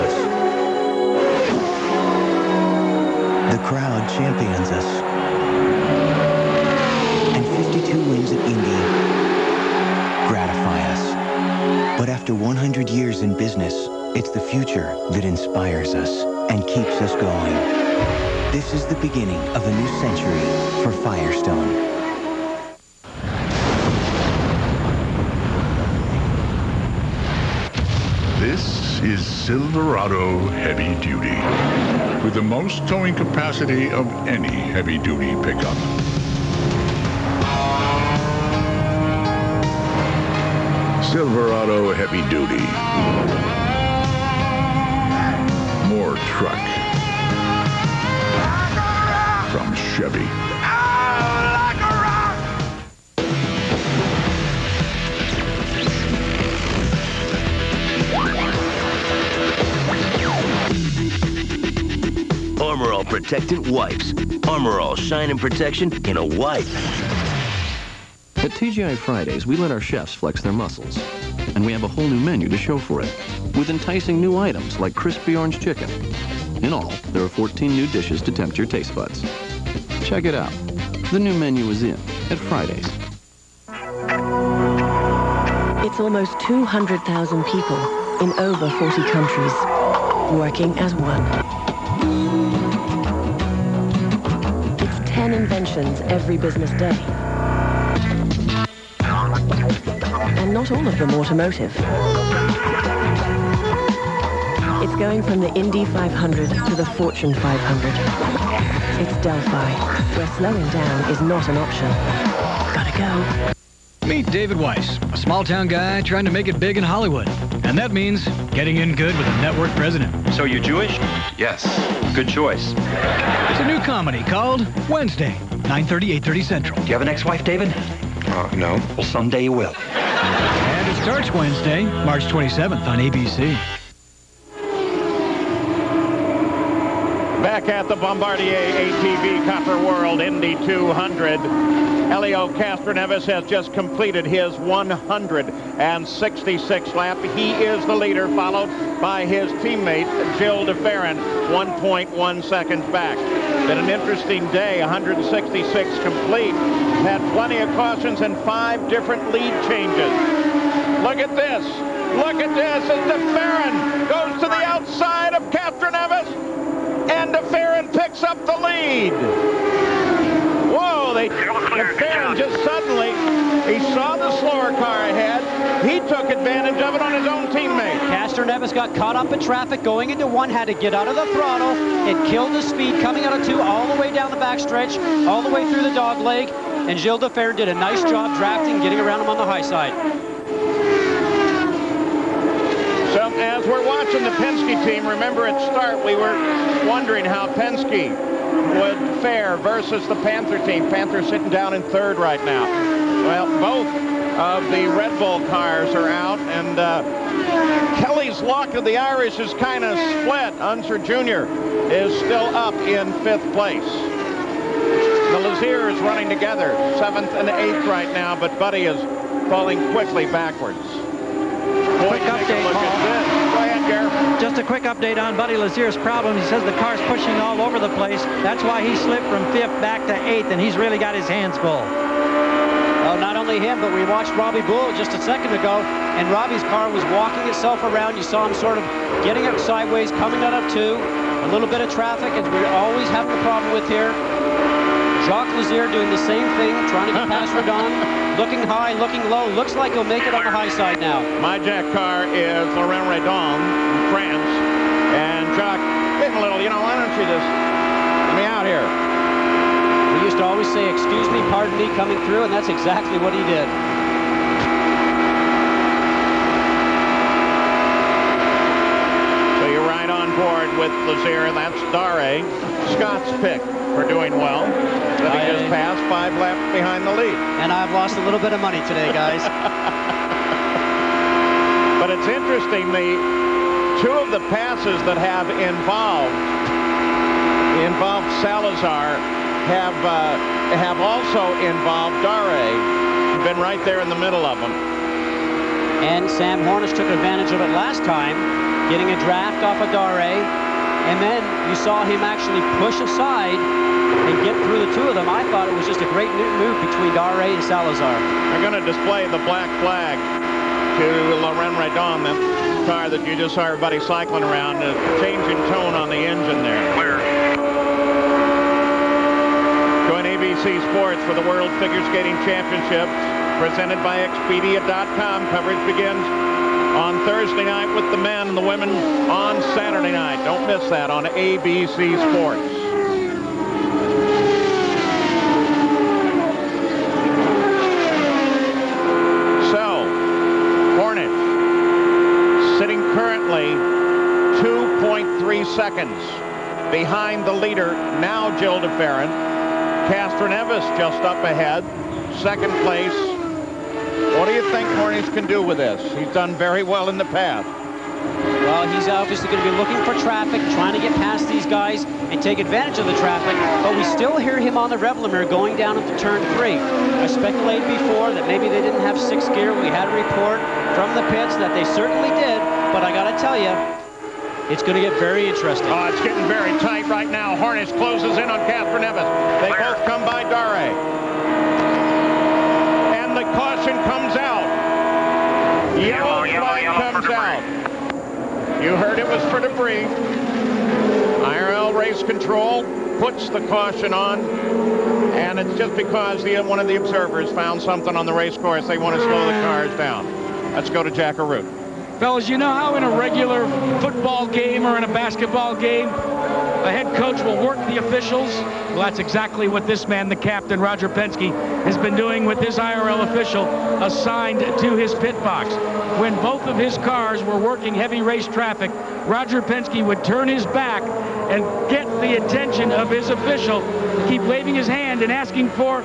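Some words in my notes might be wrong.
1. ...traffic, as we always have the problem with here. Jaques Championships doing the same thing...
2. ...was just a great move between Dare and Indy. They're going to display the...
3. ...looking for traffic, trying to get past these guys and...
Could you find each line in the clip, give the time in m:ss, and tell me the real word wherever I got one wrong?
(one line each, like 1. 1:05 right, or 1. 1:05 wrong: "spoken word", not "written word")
1. 4:01 wrong: "Lazier", not "Championships"
2. 5:05 wrong: "Salazar", not "Indy"
3. 5:59 right.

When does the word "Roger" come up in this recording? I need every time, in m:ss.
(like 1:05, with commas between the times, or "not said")
6:50, 6:59.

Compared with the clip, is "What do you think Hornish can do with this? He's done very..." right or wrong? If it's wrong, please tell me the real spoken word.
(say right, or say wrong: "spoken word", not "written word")
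right.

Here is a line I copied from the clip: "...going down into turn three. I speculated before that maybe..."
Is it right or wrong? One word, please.
right.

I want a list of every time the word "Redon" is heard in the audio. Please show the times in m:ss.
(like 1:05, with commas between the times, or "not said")
4:07, 4:13, 5:11.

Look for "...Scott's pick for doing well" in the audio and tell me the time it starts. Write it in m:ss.
4:32.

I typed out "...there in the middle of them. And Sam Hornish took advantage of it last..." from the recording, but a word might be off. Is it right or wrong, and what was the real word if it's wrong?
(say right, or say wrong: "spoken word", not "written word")
right.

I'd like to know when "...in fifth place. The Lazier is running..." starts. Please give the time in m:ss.
3:32.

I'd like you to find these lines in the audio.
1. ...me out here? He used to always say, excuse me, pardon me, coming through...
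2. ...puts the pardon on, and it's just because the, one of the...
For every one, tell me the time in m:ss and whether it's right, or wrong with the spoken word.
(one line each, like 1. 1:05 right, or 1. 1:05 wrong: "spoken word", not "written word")
1. 4:18 right
2. 6:33 wrong: "caution", not "pardon".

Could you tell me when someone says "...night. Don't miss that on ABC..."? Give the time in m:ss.
5:30.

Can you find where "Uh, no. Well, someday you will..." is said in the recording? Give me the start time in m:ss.
2:08.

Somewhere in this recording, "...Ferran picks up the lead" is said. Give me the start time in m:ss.
2:47.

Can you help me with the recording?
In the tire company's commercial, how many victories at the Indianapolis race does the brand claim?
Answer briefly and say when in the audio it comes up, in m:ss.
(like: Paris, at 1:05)
52, at 0:07.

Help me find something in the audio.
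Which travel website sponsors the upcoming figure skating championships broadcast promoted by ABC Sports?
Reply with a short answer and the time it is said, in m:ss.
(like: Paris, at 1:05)
Expedia.com, at 5:24.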